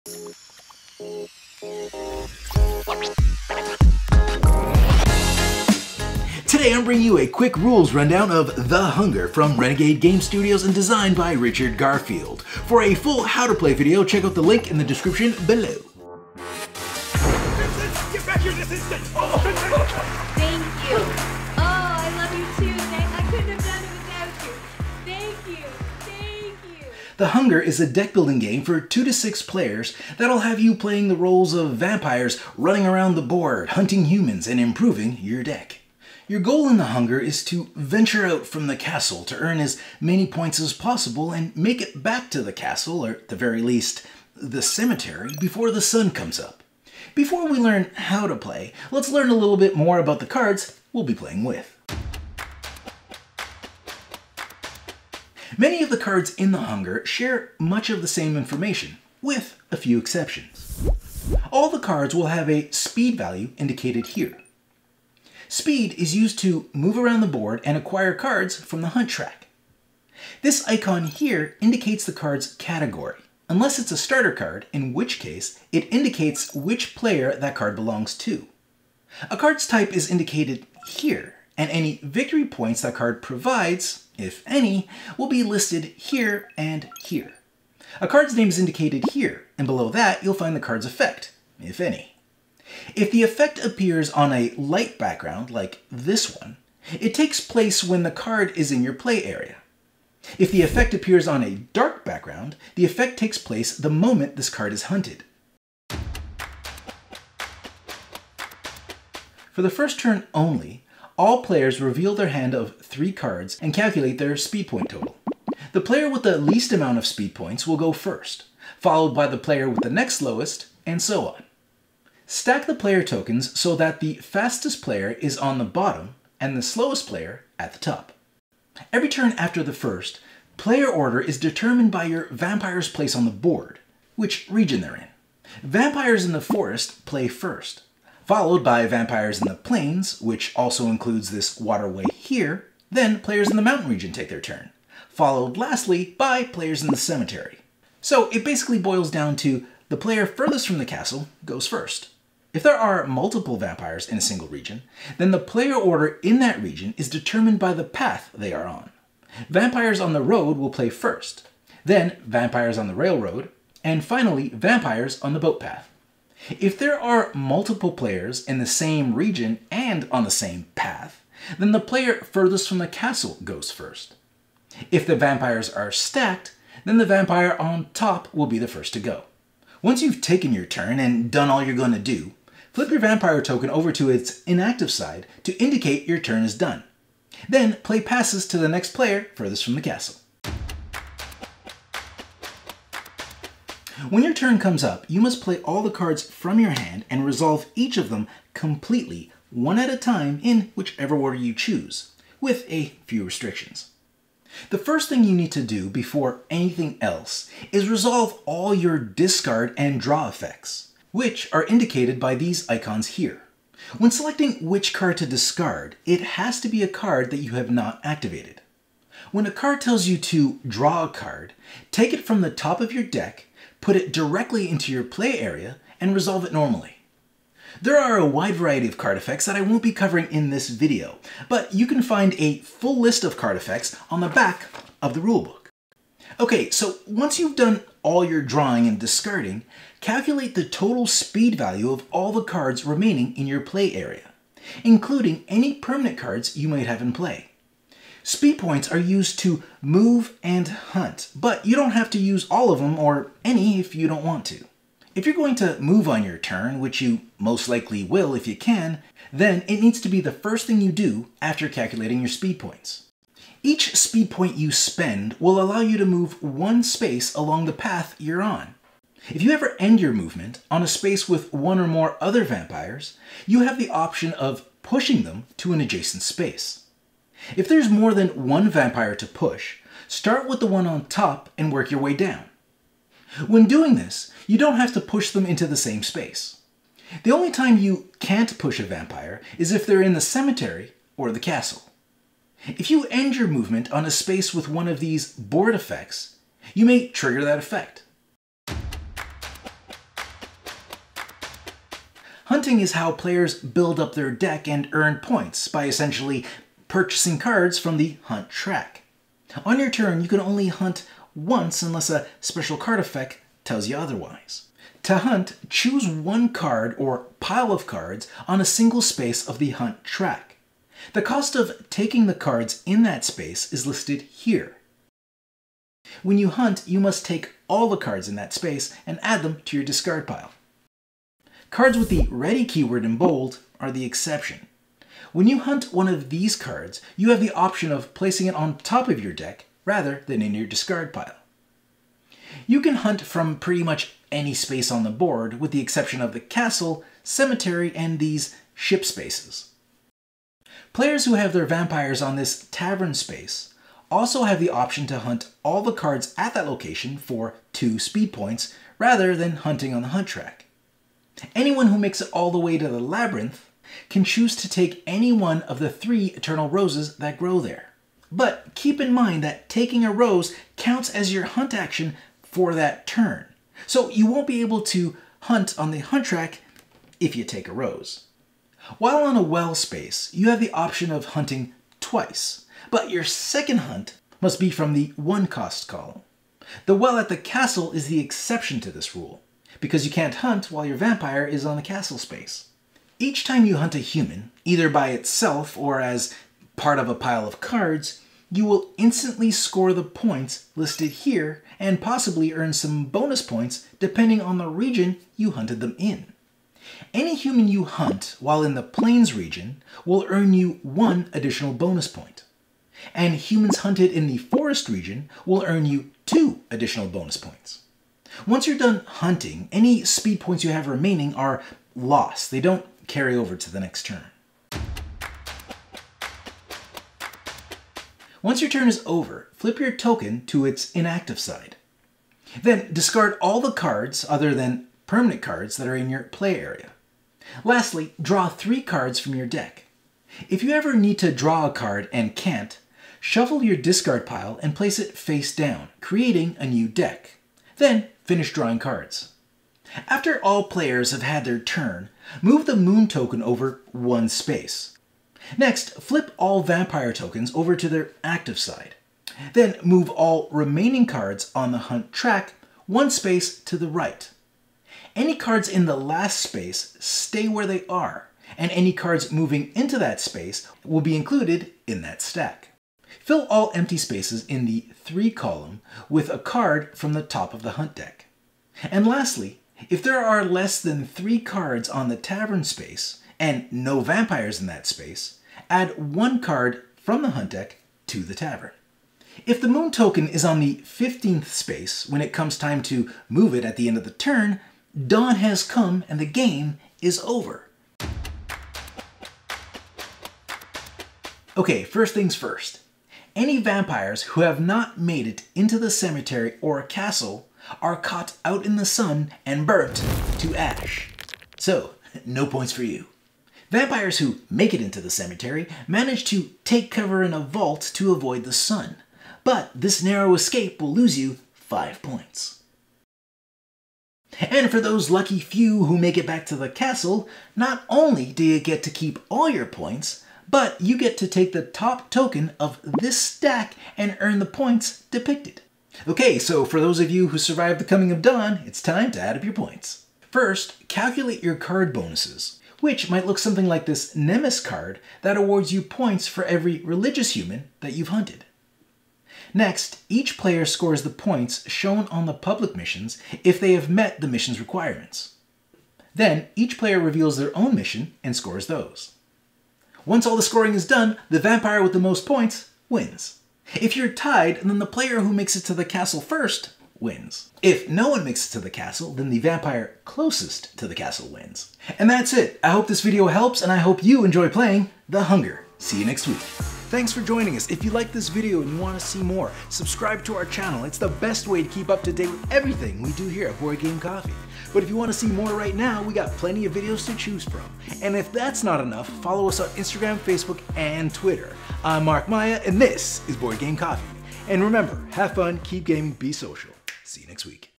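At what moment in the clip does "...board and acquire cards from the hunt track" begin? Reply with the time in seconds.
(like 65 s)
67 s.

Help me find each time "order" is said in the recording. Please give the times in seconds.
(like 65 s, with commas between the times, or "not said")
130 s, 155 s, 201 s.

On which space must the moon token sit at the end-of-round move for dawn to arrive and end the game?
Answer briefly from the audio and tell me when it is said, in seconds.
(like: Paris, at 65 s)
15th space, at 490 s.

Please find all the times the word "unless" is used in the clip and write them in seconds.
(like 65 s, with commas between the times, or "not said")
73 s, 311 s.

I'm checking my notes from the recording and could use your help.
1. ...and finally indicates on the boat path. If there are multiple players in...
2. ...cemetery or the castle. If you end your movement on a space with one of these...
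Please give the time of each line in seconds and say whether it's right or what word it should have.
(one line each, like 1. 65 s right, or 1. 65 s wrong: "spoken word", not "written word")
1. 163 s wrong: "vampires", not "indicates"
2. 290 s right.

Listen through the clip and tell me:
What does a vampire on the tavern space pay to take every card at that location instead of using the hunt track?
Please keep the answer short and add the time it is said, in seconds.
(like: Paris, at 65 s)
2 speed points, at 357 s.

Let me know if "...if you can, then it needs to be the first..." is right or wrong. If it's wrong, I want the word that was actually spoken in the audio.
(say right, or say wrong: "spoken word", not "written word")
right.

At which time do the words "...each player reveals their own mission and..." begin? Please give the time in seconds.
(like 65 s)
556 s.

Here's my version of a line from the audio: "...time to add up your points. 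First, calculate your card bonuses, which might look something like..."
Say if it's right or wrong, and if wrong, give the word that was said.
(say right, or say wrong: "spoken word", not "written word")
right.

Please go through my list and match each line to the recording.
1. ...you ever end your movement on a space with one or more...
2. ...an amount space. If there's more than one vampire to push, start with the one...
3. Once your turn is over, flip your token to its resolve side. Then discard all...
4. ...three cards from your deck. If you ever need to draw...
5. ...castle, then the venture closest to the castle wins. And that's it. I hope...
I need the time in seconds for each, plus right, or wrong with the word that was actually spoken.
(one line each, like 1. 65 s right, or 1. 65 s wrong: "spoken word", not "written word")
1. 269 s right
2. 275 s wrong: "adjacent", not "amount"
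3. 428 s wrong: "inactive", not "resolve"
4. 438 s right
5. 568 s wrong: "vampire", not "venture".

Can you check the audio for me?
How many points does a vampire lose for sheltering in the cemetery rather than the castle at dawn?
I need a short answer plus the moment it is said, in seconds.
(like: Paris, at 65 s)
5, at 521 s.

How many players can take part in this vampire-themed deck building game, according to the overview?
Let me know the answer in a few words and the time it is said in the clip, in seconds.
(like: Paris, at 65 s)
2 to 6, at 28 s.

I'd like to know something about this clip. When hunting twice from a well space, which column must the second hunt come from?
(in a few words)
the one cost column.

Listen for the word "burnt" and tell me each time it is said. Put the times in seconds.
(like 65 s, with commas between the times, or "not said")
509 s.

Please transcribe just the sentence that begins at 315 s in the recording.
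To hunt, choose one card or pile of cards on a single space of the hunt track.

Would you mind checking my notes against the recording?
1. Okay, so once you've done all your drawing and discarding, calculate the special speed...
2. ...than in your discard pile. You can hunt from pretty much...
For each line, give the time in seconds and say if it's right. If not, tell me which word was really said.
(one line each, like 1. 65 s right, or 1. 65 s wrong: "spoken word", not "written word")
1. 236 s wrong: "total", not "special"
2. 340 s right.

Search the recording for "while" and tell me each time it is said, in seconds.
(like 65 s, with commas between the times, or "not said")
378 s, 390 s, 408 s.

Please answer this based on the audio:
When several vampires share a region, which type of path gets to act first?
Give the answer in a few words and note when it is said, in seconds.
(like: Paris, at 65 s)
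the road, at 159 s.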